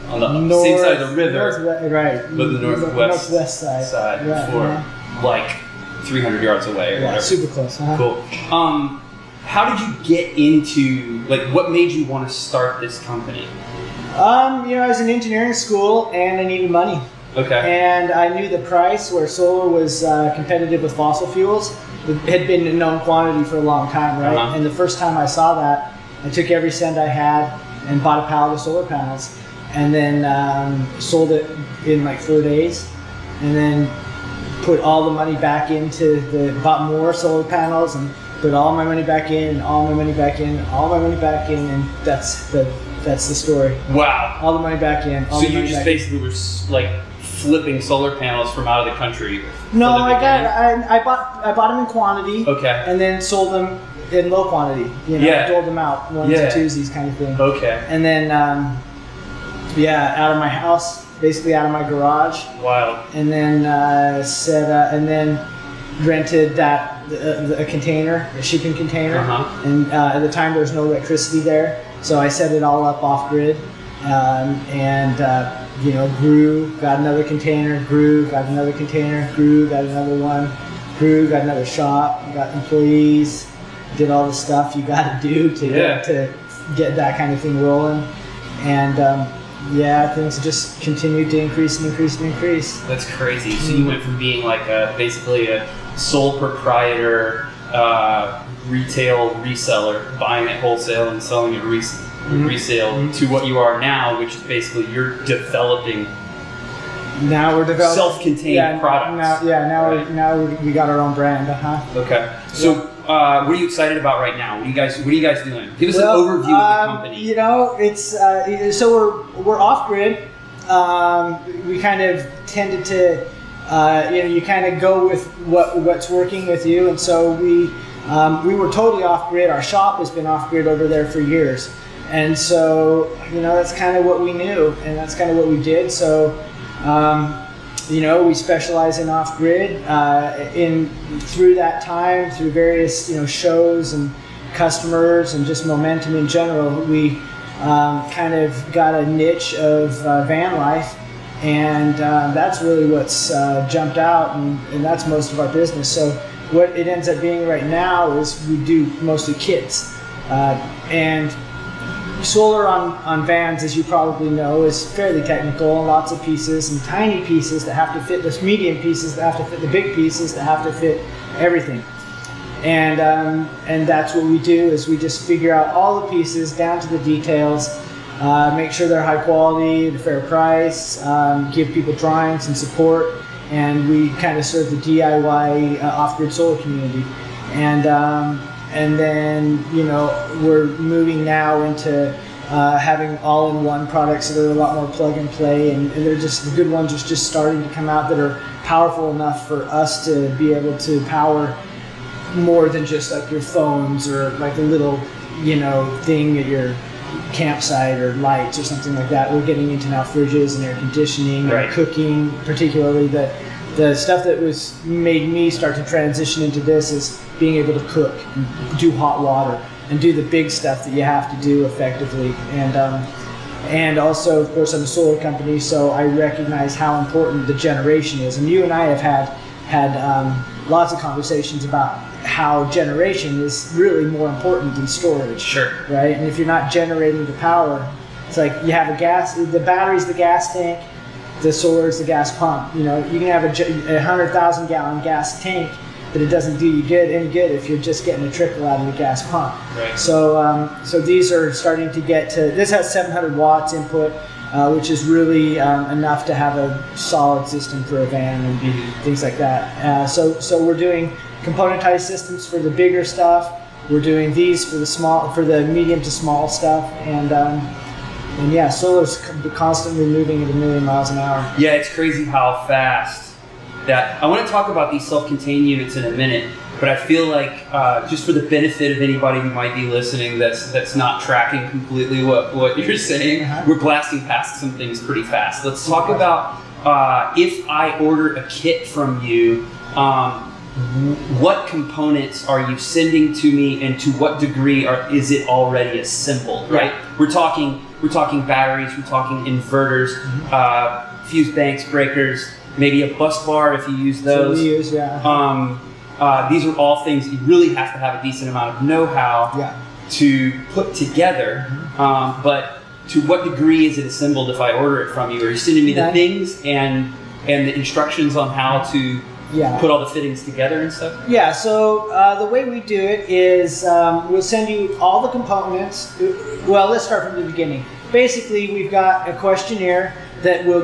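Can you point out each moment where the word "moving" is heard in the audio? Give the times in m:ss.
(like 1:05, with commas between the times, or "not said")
3:10, 4:30.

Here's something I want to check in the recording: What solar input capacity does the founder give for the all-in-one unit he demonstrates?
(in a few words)
700 watts.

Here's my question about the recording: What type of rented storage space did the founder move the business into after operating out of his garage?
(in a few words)
shipping container.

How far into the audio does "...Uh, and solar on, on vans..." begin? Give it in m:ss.
2:40.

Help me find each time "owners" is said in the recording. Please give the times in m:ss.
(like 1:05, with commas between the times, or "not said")
not said.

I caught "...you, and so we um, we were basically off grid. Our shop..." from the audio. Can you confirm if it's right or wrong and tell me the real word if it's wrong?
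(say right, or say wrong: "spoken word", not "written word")
wrong: "totally", not "basically".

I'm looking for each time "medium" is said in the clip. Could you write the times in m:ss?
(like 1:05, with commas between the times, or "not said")
2:48, 4:25.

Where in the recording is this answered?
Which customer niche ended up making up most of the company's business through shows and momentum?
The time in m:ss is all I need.
2:30.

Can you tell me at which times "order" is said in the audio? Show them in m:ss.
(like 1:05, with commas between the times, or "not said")
4:47, 5:14.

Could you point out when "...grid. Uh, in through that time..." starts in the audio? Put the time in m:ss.
2:19.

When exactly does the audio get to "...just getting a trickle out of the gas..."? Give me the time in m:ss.
4:07.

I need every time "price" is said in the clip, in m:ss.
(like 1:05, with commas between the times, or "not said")
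0:18, 3:00.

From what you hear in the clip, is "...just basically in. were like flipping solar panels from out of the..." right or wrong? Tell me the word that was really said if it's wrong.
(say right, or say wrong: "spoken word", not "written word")
right.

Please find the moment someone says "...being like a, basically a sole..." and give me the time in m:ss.
1:34.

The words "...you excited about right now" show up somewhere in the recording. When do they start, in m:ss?
1:53.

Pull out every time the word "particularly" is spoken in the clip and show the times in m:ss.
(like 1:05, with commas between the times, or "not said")
3:32.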